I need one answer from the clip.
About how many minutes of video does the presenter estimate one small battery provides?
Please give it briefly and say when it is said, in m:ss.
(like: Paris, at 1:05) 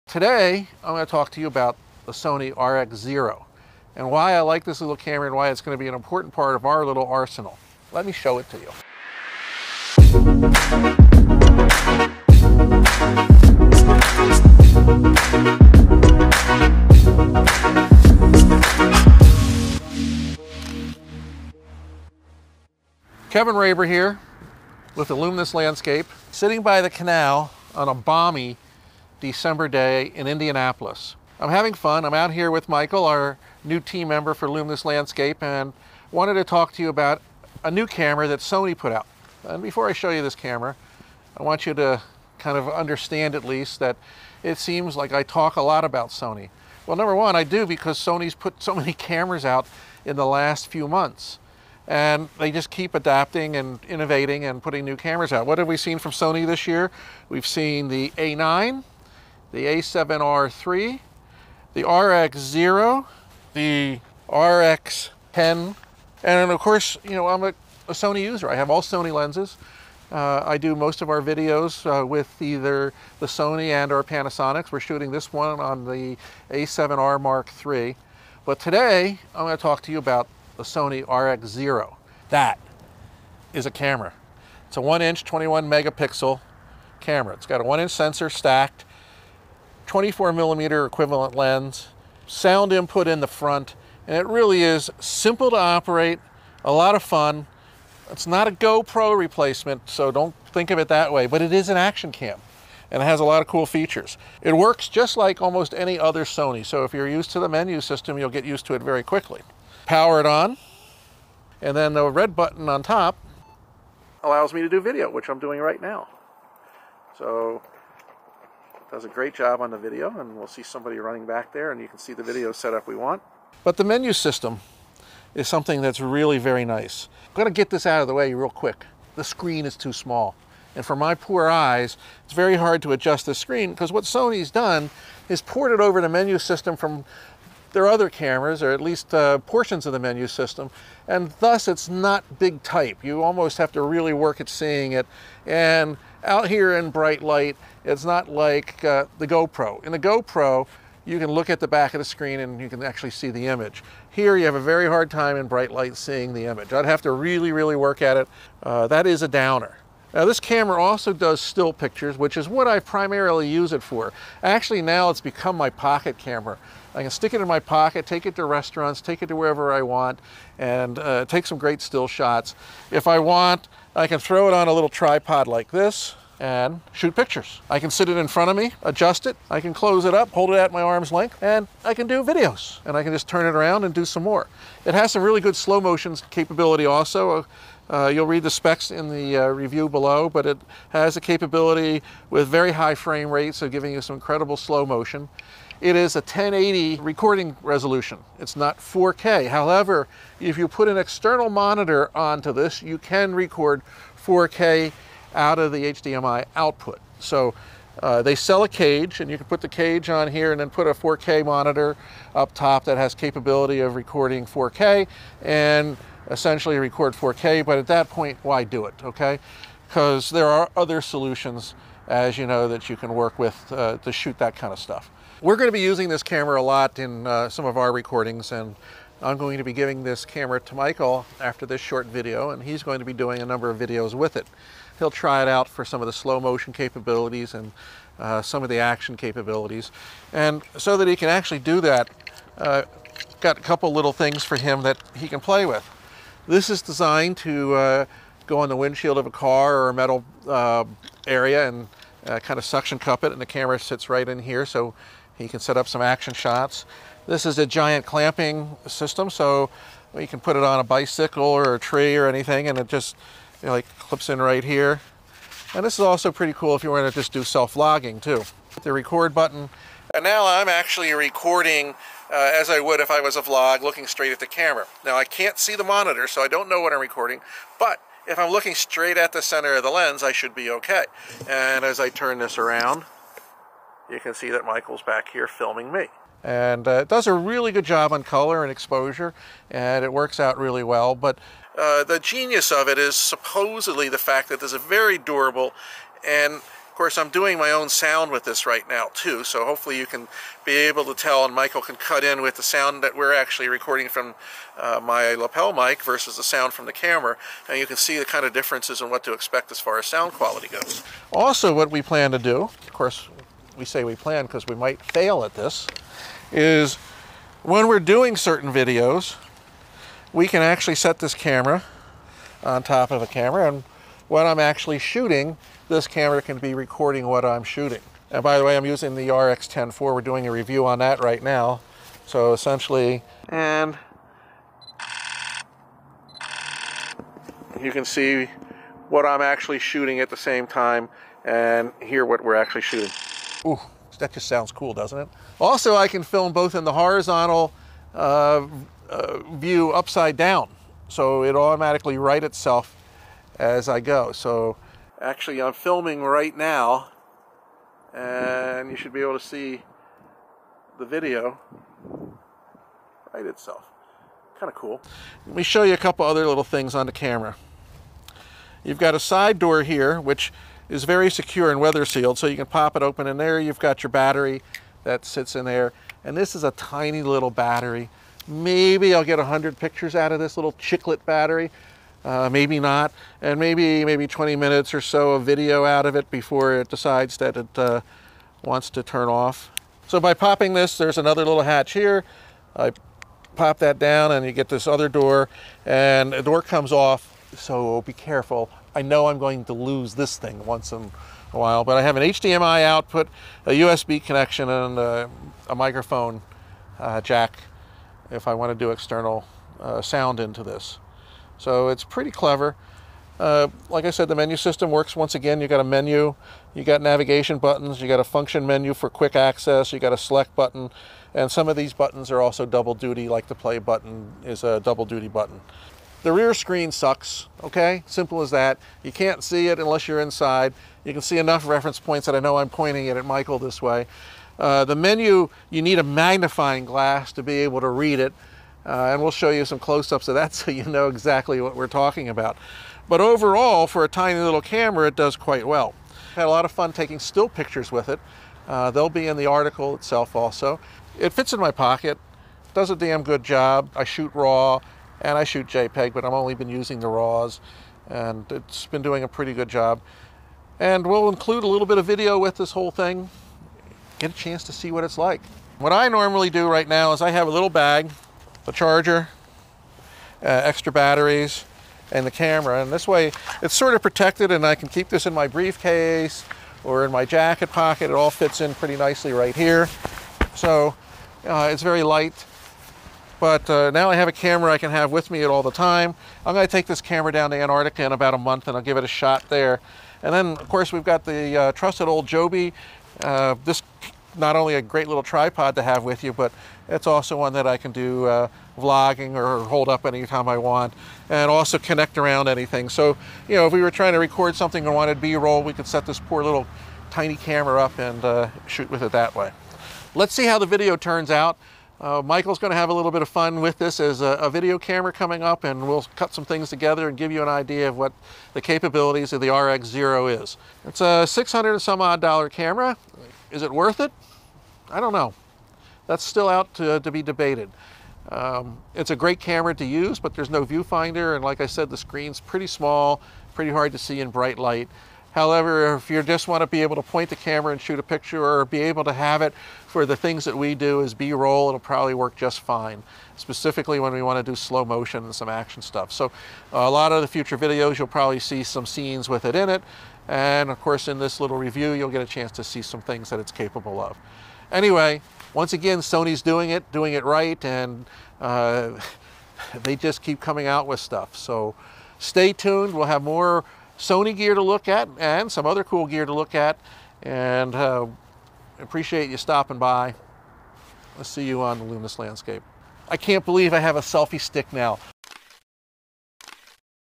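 20 minutes, at 6:24.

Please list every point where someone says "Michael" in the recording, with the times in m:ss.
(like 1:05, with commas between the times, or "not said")
0:32, 3:50, 4:44, 5:01, 7:13, 8:32.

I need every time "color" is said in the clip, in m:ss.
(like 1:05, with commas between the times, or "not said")
4:48.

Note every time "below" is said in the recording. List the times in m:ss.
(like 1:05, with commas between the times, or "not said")
3:09.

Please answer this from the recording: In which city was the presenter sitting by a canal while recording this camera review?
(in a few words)
Indianapolis.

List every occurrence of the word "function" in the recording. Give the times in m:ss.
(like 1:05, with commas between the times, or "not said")
6:58.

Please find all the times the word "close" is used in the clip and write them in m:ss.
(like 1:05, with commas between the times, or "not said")
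2:59, 7:19.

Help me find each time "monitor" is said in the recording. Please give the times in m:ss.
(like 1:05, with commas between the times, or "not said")
3:21, 3:31, 4:35.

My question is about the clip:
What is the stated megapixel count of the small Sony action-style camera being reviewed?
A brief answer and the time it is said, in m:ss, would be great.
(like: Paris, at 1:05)
21, at 1:25.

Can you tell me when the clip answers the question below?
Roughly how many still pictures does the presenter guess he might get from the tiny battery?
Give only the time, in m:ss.
6:19.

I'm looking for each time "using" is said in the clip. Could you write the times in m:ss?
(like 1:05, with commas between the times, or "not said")
3:45, 5:28, 7:36.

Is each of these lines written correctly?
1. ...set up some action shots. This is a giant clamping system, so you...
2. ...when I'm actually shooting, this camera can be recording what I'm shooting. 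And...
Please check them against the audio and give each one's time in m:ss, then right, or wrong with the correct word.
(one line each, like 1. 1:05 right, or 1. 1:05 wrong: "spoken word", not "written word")
1. 4:15 right
2. 5:24 right.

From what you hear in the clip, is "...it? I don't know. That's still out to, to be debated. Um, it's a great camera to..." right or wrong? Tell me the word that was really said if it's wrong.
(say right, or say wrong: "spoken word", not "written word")
right.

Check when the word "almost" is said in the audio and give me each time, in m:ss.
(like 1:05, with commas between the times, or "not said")
1:45, 2:23.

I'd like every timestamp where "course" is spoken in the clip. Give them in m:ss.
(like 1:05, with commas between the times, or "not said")
1:06, 4:56, 5:12, 8:10, 9:10.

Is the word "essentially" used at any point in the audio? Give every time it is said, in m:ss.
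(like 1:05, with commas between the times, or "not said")
3:36, 5:32.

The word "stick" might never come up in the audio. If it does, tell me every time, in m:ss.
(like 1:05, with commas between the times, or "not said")
2:47, 9:34.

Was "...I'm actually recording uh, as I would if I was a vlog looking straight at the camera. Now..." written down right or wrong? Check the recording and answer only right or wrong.
right.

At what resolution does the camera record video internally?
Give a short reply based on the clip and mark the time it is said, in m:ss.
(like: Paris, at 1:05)
1080, at 3:16.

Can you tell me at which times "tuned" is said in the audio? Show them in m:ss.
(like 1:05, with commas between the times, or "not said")
9:22.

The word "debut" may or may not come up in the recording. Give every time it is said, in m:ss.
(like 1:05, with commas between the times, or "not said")
not said.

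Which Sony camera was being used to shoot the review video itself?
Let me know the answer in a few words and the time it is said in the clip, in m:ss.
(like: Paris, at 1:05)
A7R Mark III, at 1:16.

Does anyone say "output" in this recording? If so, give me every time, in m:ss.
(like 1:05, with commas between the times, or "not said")
3:26, 6:42.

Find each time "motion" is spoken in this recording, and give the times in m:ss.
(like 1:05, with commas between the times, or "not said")
3:05, 3:14, 3:56, 9:04.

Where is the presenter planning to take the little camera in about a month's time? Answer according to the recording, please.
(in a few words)
Antarctica.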